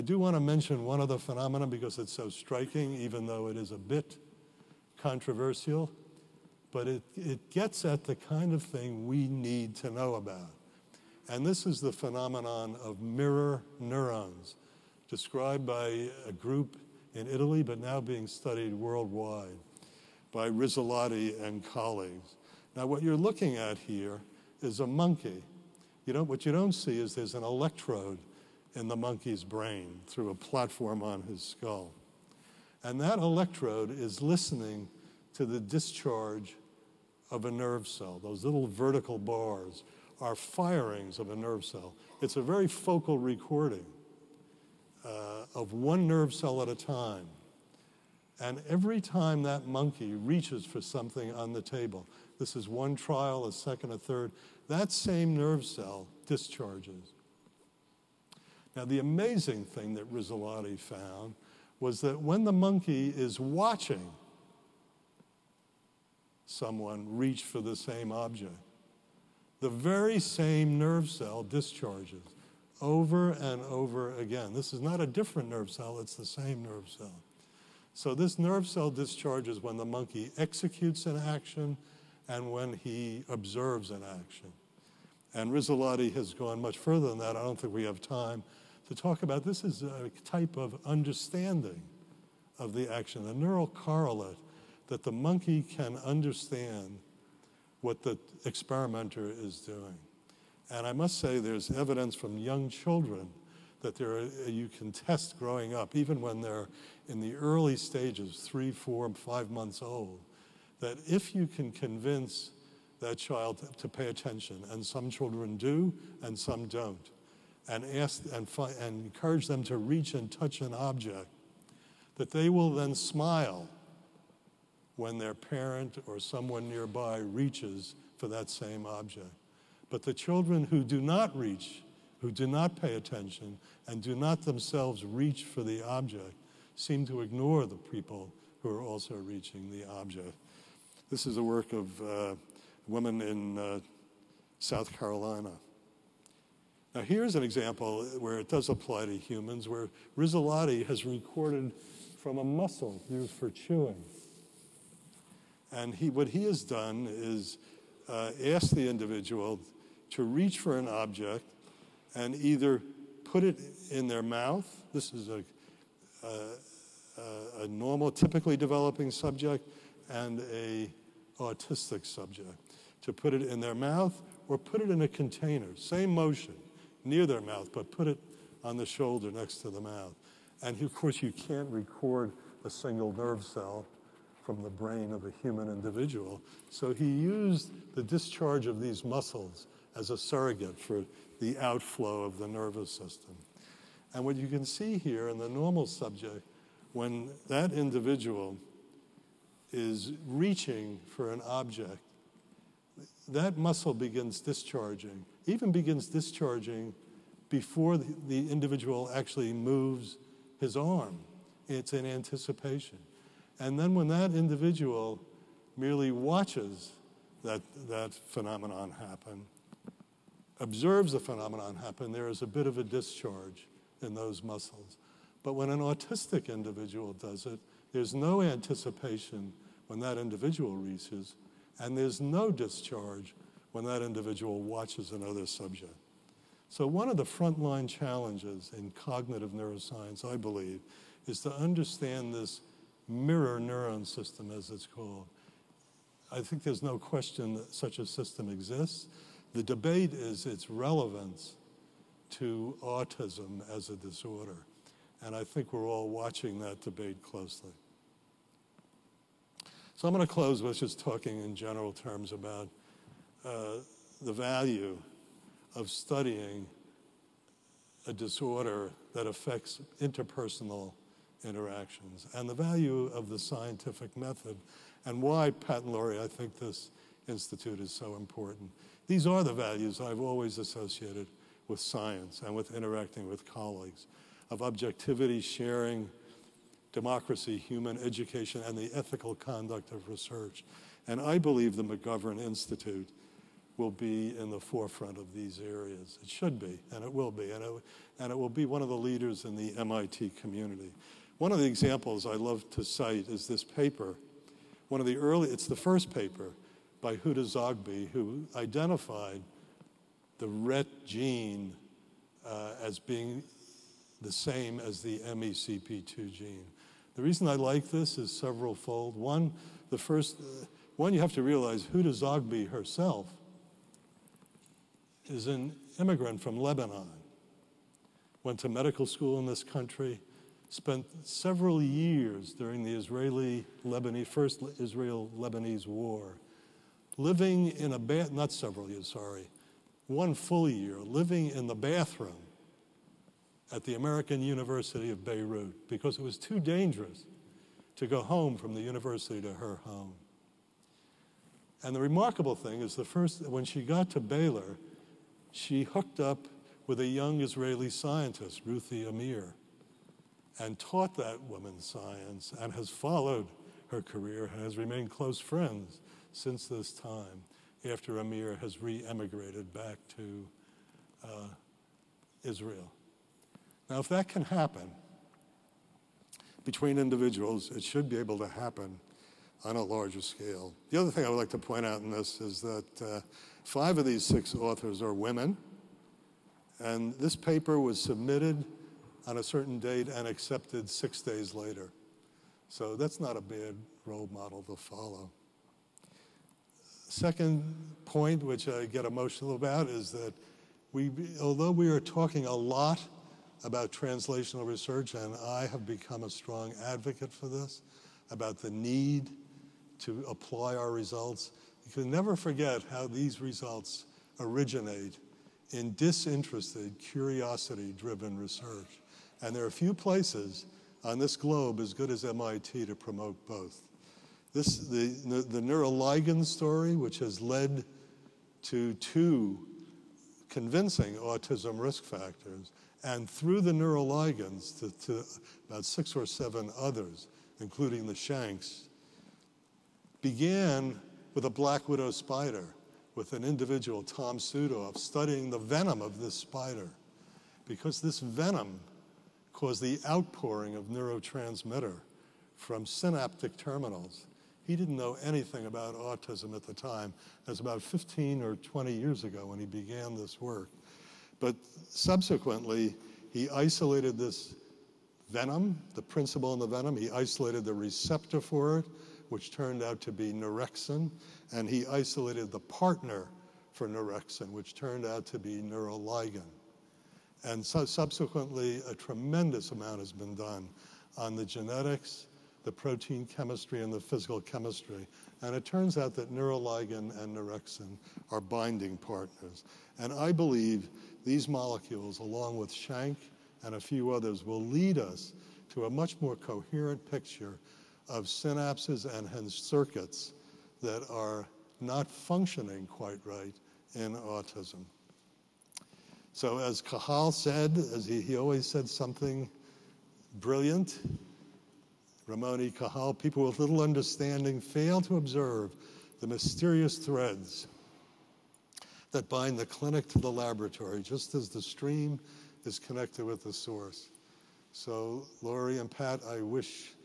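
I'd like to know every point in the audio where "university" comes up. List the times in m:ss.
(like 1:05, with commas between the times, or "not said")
5:44, 5:48.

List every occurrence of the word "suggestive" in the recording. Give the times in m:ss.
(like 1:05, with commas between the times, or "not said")
not said.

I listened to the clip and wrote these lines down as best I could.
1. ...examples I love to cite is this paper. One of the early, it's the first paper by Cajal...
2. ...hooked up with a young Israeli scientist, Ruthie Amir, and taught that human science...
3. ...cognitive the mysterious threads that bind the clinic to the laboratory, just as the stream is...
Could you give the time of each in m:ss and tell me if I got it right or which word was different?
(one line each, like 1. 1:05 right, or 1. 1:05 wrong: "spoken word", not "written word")
1. 5:01 wrong: "Huda", not "Cajal"
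2. 5:55 wrong: "woman", not "human"
3. 8:35 wrong: "observe", not "cognitive".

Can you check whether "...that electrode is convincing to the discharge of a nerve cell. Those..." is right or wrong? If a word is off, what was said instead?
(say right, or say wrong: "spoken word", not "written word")
wrong: "listening", not "convincing".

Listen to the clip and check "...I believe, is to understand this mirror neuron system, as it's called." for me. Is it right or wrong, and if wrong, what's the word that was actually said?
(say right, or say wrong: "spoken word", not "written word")
right.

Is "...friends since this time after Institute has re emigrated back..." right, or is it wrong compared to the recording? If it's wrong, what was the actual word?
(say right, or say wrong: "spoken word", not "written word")
wrong: "Amir", not "Institute".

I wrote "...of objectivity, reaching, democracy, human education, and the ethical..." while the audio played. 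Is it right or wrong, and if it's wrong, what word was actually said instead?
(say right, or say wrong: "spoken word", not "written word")
wrong: "sharing", not "reaching".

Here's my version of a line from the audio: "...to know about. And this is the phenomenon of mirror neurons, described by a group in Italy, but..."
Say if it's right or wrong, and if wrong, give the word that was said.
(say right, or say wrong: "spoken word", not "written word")
right.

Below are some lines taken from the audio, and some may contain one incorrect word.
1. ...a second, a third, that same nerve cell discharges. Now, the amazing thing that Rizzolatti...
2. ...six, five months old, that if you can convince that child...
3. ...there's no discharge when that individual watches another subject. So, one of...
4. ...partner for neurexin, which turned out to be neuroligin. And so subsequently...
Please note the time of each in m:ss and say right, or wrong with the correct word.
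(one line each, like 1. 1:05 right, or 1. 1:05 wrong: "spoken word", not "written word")
1. 0:53 right
2. 1:48 wrong: "four", not "six"
3. 3:51 right
4. 7:52 right.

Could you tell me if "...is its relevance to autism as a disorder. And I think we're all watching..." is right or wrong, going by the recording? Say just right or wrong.
right.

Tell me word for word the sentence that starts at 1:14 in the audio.
This is not a different nerve cell, it's the same nerve cell.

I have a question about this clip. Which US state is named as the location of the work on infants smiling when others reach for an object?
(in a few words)
South Carolina.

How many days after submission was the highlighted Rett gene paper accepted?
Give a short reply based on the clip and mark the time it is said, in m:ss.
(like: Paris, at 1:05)
6, at 6:30.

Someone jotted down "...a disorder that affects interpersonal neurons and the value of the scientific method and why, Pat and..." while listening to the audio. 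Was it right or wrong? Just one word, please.
wrong.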